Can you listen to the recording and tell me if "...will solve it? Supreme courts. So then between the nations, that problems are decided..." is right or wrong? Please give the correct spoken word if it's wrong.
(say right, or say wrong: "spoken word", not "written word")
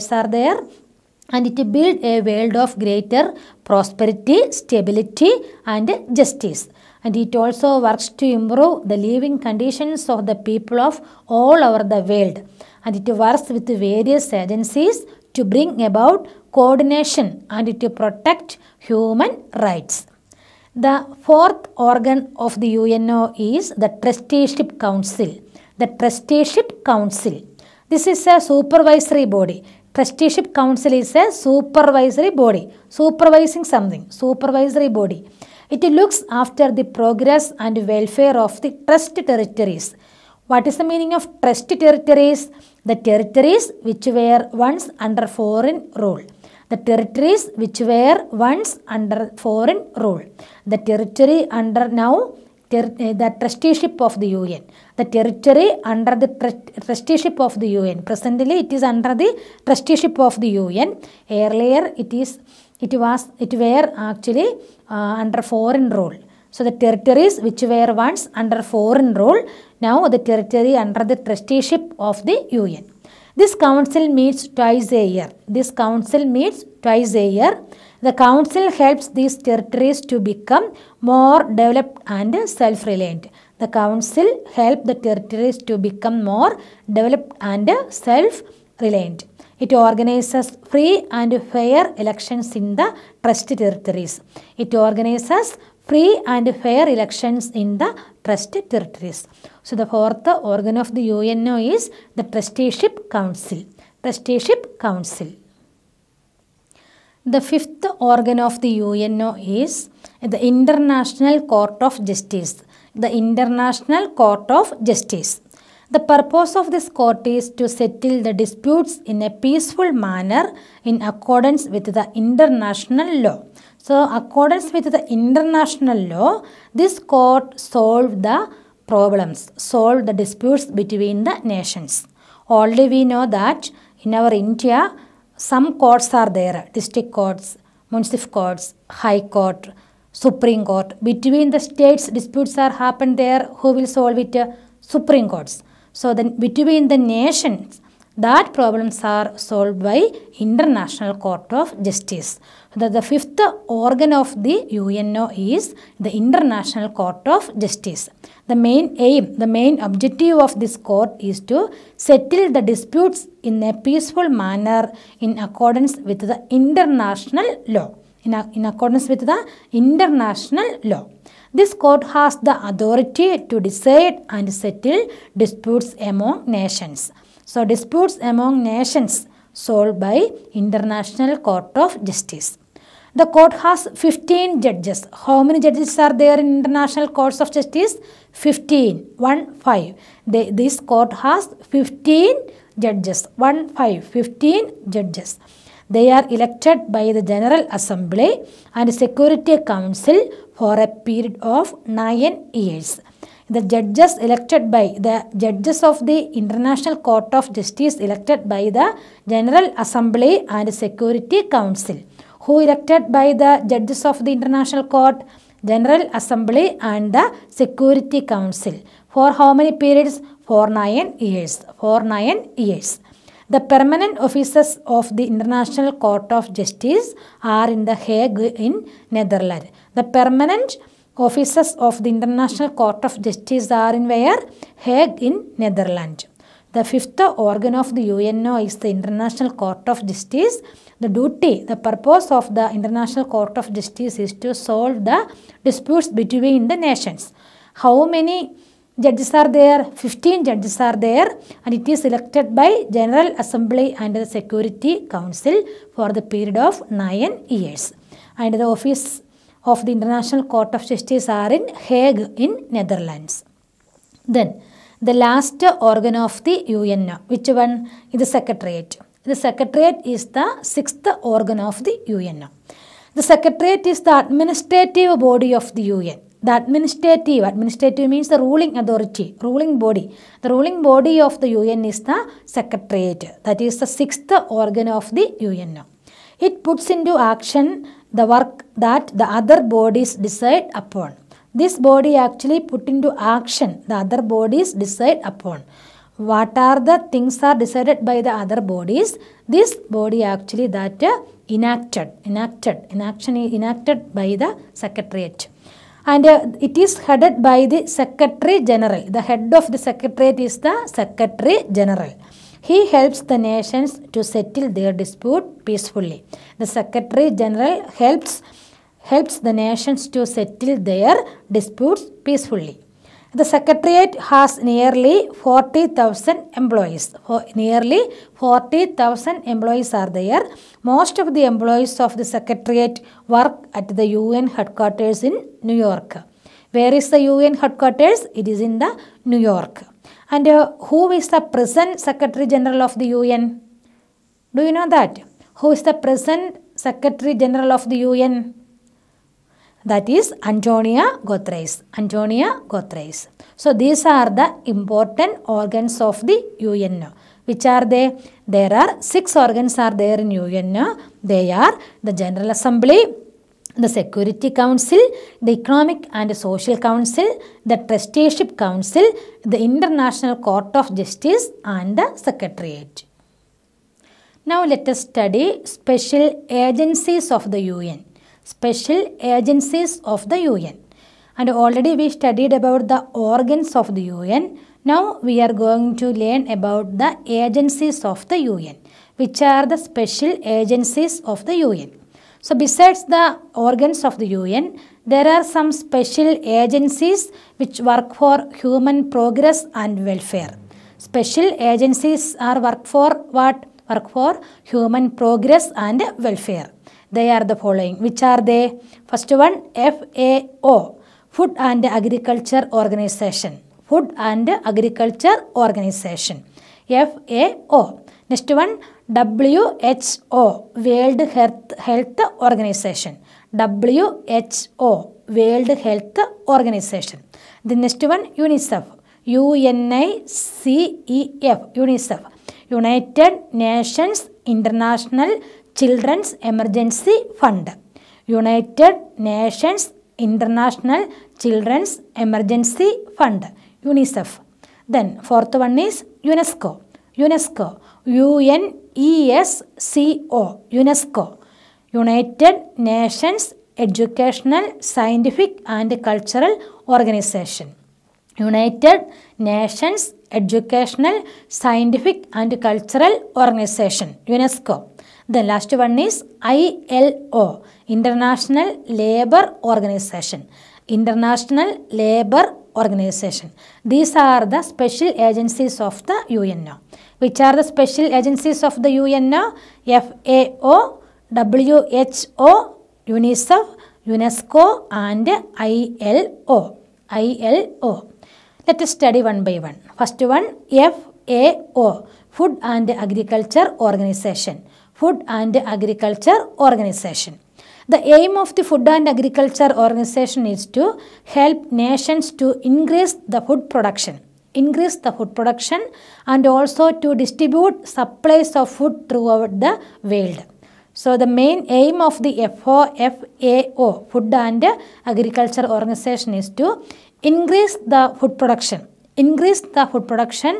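wrong: "solved", not "decided".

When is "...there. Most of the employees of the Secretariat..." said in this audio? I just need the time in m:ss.
5:30.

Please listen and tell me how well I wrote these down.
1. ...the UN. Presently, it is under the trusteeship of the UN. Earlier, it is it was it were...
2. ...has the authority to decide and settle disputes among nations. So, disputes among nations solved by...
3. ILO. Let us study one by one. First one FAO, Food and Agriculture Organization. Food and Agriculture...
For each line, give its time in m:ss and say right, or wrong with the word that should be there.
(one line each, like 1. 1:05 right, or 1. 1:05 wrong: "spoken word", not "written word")
1. 0:57 right
2. 2:52 right
3. 8:07 right.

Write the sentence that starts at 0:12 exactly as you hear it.
And it works with various agencies to bring about coordination and to protect human rights.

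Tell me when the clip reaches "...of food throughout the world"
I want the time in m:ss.
8:28.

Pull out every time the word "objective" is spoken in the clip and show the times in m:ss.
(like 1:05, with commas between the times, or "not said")
2:39.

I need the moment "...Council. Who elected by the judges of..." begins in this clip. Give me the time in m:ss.
3:31.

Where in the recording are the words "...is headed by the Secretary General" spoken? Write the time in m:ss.
5:06.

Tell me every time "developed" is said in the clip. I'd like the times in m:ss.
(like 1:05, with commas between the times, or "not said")
1:21, 1:26.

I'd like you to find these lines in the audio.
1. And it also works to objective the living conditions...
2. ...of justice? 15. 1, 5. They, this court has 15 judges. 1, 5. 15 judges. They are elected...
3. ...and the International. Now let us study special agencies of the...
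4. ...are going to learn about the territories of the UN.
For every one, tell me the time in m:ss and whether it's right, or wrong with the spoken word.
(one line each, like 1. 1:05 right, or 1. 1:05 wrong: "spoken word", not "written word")
1. 0:07 wrong: "improve", not "objective"
2. 3:07 right
3. 6:11 wrong: "Secretariat", not "International"
4. 6:25 wrong: "agencies", not "territories".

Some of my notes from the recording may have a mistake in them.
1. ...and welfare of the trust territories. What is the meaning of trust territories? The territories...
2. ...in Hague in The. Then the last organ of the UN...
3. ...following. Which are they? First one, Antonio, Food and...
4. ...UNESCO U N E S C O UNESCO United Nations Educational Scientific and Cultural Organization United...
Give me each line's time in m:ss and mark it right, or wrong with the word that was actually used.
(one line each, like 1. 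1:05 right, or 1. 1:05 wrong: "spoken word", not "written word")
1. 0:37 right
2. 4:21 wrong: "Netherlands", not "The"
3. 6:47 wrong: "FAO", not "Antonio"
4. 7:27 right.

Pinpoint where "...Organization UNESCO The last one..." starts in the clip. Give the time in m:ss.
7:43.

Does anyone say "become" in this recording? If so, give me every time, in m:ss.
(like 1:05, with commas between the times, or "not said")
1:20, 1:25.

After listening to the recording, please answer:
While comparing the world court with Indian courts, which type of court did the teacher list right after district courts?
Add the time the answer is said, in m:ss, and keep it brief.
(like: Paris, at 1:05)
Municipal courts, at 2:17.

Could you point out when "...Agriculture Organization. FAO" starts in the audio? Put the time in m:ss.
6:54.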